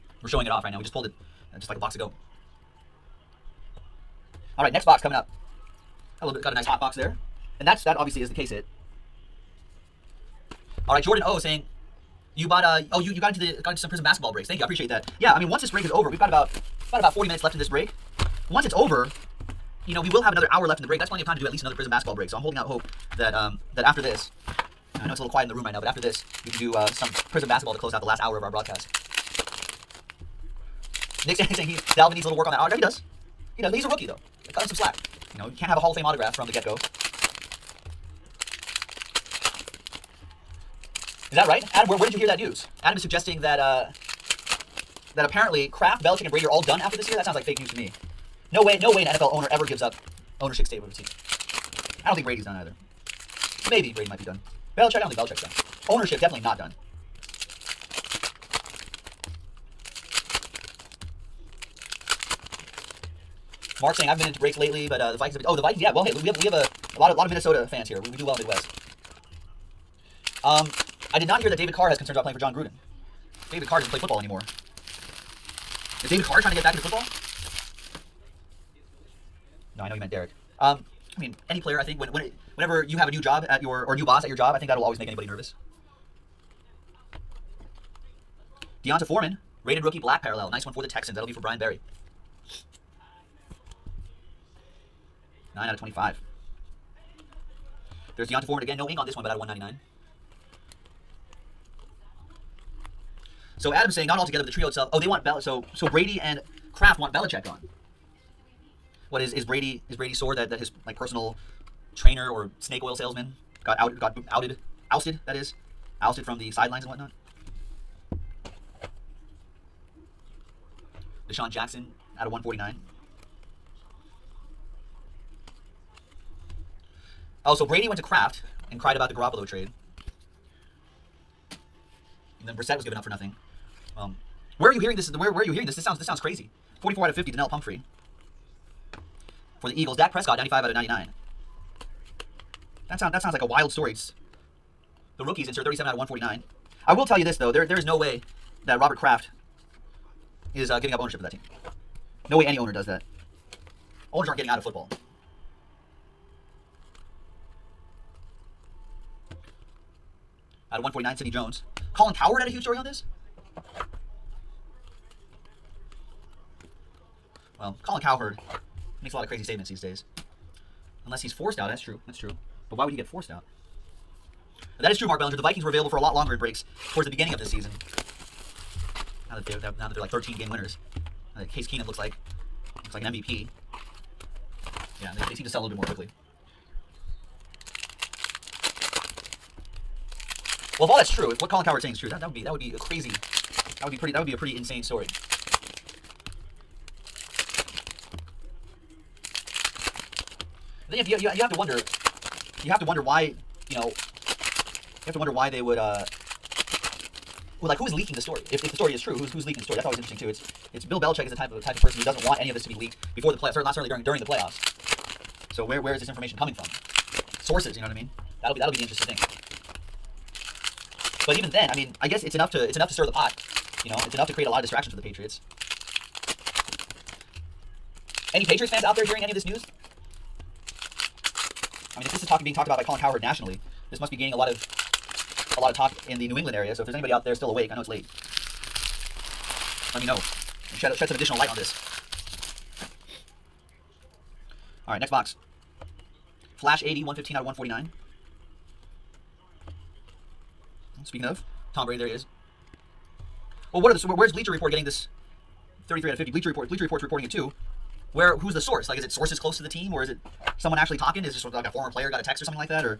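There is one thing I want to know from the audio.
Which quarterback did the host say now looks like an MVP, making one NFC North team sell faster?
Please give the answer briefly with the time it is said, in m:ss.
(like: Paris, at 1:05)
Case Keenum, at 3:01.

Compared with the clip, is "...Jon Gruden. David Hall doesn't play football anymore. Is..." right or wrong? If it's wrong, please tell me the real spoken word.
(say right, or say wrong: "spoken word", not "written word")
wrong: "Carr", not "Hall".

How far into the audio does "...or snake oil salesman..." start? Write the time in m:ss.
1:52.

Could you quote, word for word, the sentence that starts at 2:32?
No way any owner does that.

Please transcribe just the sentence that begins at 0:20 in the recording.
That's plenty of time to do at least another Prizm basketball break.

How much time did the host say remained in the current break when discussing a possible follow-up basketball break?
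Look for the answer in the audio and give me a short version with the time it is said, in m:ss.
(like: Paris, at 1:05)
40 minutes, at 0:17.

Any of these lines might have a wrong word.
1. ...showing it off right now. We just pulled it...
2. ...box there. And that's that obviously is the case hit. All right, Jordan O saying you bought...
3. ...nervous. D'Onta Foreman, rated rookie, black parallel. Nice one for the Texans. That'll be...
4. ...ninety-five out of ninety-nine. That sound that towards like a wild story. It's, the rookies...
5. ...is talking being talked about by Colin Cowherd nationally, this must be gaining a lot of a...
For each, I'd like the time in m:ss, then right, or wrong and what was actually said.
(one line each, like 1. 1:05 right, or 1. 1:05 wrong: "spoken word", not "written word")
1. 0:00 right
2. 0:06 right
3. 1:25 right
4. 2:20 wrong: "sounds", not "towards"
5. 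3:52 right.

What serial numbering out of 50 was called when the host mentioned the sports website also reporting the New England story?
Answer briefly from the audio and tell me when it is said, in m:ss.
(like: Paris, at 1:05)
33 out of 50, at 4:15.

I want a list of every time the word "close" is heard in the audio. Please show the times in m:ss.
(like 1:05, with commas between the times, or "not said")
0:27, 4:19.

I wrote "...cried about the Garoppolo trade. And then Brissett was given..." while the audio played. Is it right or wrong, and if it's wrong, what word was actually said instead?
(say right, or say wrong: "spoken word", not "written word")
right.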